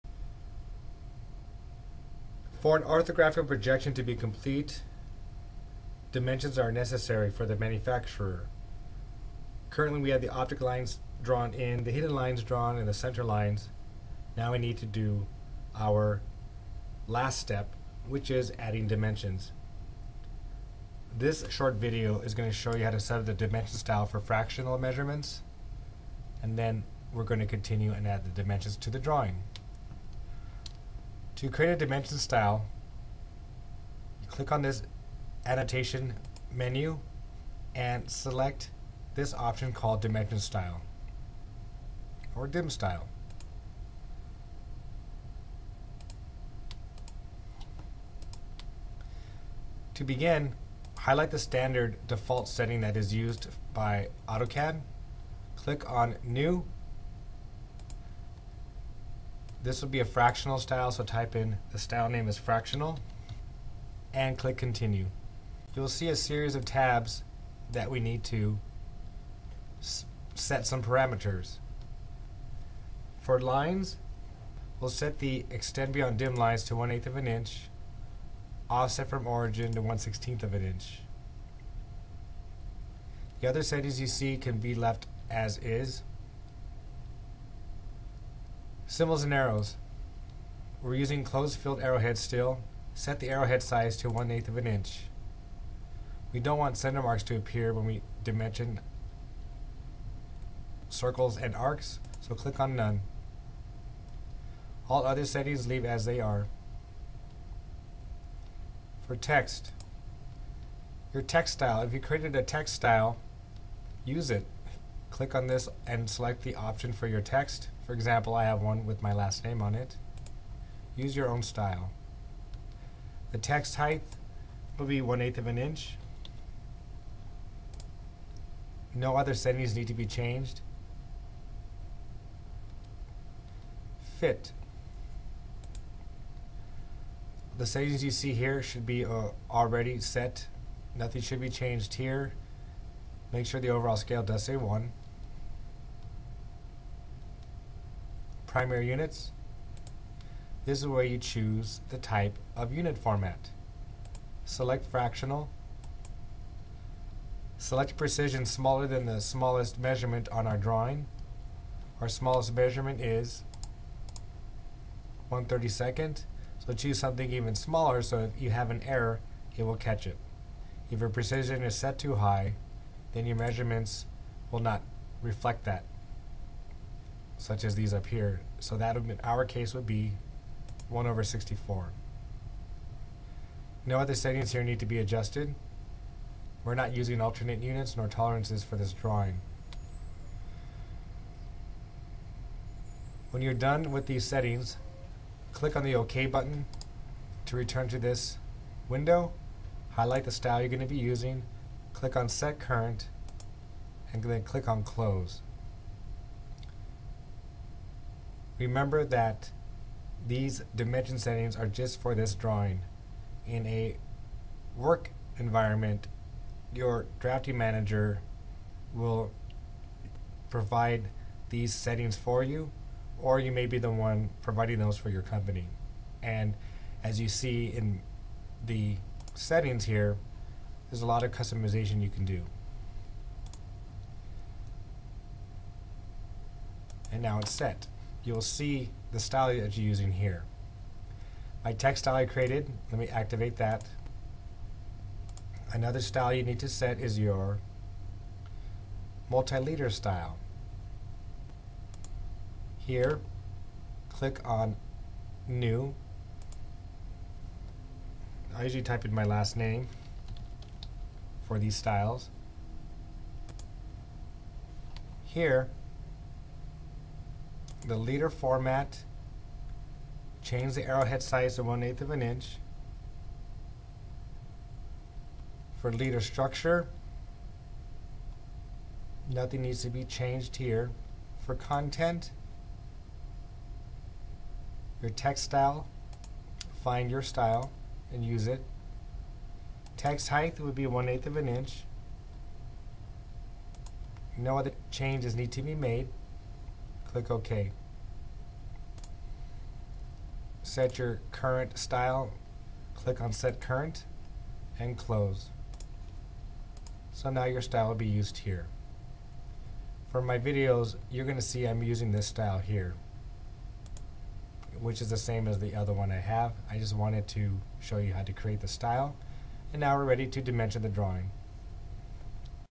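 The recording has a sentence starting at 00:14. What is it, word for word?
Now we need to do our last step, which is adding dimensions.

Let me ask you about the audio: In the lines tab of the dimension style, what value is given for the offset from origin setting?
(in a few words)
1/16 inch.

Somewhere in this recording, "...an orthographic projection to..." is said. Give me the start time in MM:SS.
00:02.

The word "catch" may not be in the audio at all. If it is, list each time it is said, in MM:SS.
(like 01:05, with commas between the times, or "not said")
02:49.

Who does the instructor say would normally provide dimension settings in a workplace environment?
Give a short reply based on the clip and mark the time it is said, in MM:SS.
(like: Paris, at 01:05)
drafting manager, at 03:37.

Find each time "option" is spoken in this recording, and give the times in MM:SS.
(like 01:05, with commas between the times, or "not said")
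00:39, 01:56.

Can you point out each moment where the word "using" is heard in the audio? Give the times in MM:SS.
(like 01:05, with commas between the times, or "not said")
01:30, 03:06, 03:20, 03:59, 05:11.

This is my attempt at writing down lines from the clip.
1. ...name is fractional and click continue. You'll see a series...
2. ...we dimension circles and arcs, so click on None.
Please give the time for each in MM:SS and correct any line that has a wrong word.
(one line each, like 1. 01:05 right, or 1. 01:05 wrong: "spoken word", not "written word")
1. 01:02 right
2. 01:37 right.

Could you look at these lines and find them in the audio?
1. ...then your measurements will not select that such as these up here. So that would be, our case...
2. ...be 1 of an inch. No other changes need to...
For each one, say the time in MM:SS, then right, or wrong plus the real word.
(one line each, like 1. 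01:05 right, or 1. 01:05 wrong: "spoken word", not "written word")
1. 02:53 wrong: "reflect", not "select"
2. 04:50 right.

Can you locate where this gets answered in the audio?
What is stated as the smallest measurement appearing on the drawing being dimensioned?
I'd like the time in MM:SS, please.
02:45.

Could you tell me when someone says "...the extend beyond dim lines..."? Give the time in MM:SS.
01:15.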